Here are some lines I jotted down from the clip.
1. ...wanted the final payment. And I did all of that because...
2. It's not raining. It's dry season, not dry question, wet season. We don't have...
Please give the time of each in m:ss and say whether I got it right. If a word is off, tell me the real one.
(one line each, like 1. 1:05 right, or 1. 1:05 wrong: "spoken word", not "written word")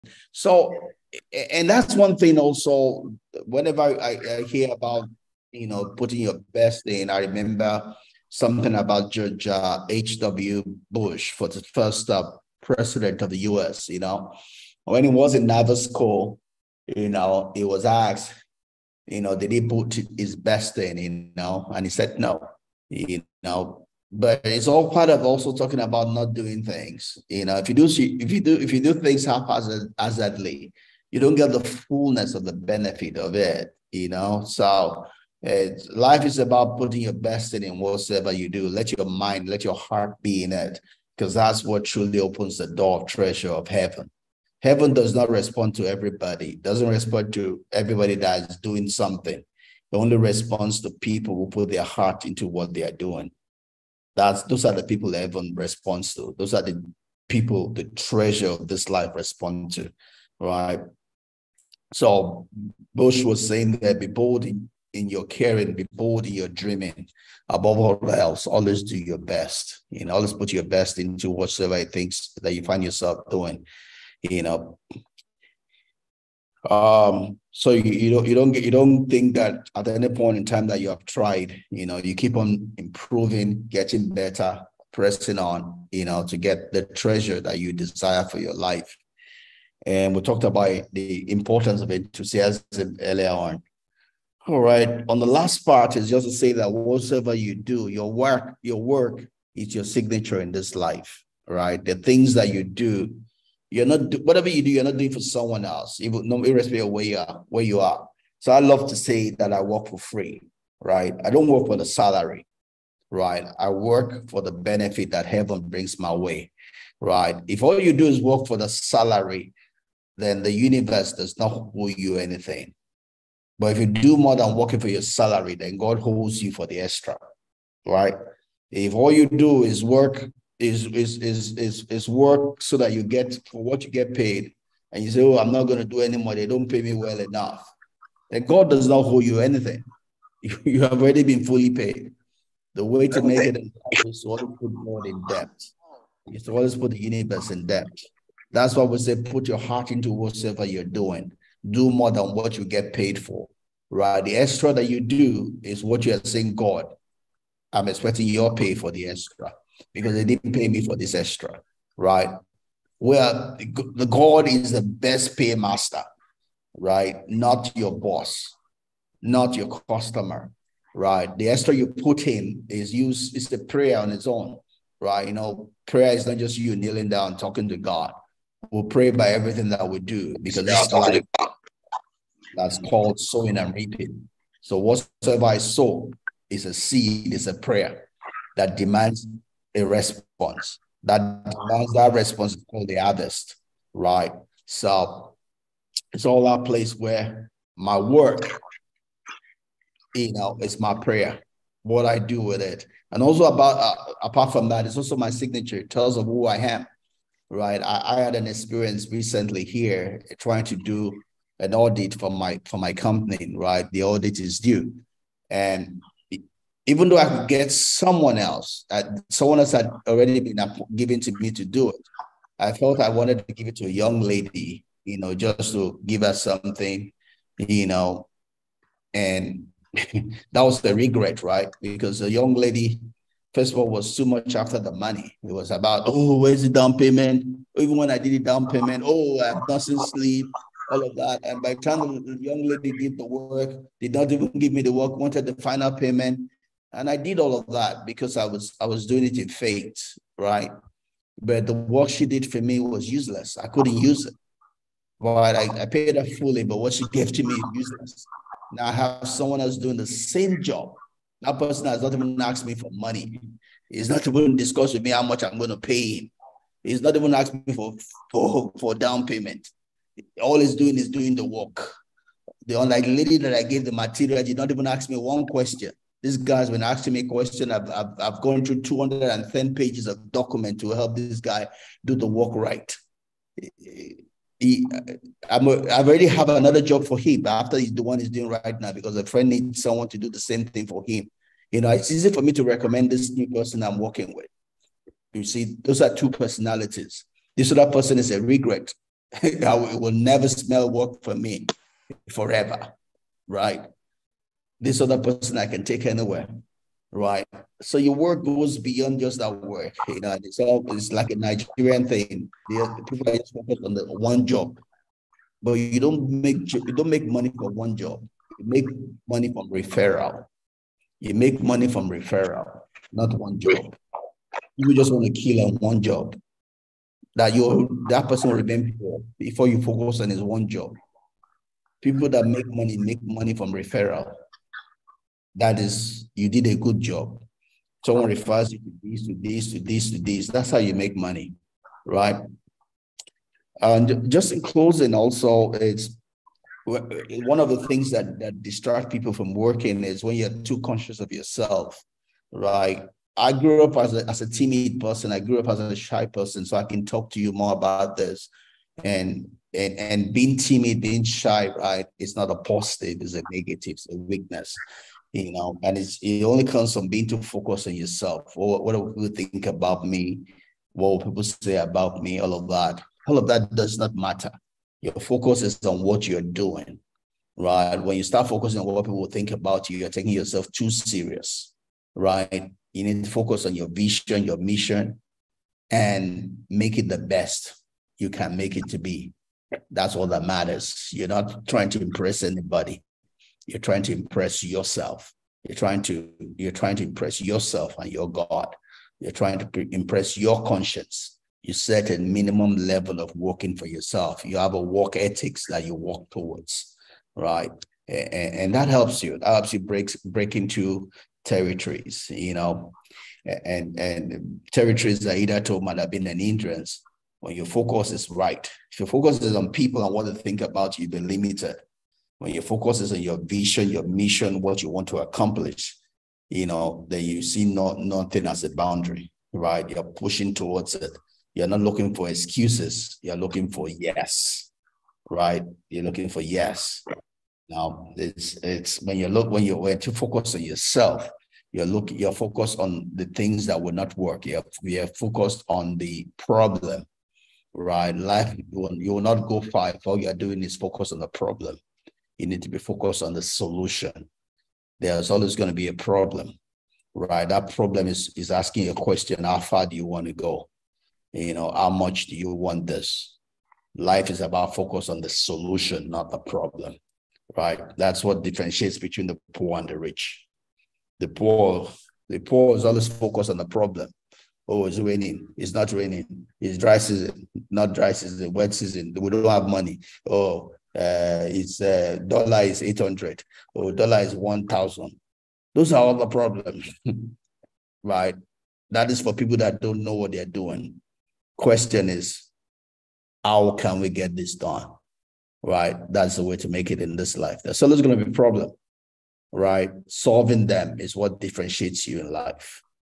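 1. 4:05 right
2. 7:55 wrong: "season", not "question".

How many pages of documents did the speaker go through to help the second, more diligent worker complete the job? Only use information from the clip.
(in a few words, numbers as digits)
210.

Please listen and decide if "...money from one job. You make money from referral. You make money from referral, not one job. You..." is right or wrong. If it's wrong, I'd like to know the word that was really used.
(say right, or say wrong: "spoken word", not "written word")
right.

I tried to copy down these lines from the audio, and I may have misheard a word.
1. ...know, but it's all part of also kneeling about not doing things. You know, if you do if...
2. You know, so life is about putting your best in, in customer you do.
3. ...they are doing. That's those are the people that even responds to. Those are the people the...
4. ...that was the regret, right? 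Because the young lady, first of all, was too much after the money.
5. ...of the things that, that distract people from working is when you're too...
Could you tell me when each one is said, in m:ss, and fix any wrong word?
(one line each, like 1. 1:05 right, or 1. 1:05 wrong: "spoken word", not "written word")
1. 0:23 wrong: "talking", not "kneeling"
2. 0:33 wrong: "whatsoever", not "customer"
3. 0:52 right
4. 3:49 right
5. 5:47 right.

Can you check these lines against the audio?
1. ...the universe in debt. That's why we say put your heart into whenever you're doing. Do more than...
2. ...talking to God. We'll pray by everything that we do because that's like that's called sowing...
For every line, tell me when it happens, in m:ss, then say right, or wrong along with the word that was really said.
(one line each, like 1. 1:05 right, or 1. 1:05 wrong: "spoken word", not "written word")
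1. 2:26 wrong: "whatever", not "whenever"
2. 2:57 right.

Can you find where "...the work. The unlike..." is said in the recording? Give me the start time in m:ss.
4:31.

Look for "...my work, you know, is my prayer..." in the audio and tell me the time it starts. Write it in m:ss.
3:17.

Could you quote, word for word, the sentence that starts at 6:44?
You have a work ethics that you walk towards, right?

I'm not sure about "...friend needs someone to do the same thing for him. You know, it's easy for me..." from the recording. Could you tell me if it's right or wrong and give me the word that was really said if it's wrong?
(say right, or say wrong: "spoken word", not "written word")
right.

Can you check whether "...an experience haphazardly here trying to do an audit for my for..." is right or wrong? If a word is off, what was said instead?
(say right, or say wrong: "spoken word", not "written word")
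wrong: "recently", not "haphazardly".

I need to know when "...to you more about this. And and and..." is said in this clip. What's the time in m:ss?
5:57.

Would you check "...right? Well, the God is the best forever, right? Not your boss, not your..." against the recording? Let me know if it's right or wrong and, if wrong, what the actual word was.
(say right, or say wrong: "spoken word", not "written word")
wrong: "paymaster", not "forever".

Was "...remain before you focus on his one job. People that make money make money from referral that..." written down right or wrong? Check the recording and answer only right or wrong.
right.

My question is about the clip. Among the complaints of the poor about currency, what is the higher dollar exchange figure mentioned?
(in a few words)
1000.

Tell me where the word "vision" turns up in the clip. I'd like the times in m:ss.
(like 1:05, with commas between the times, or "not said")
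6:23, 7:03.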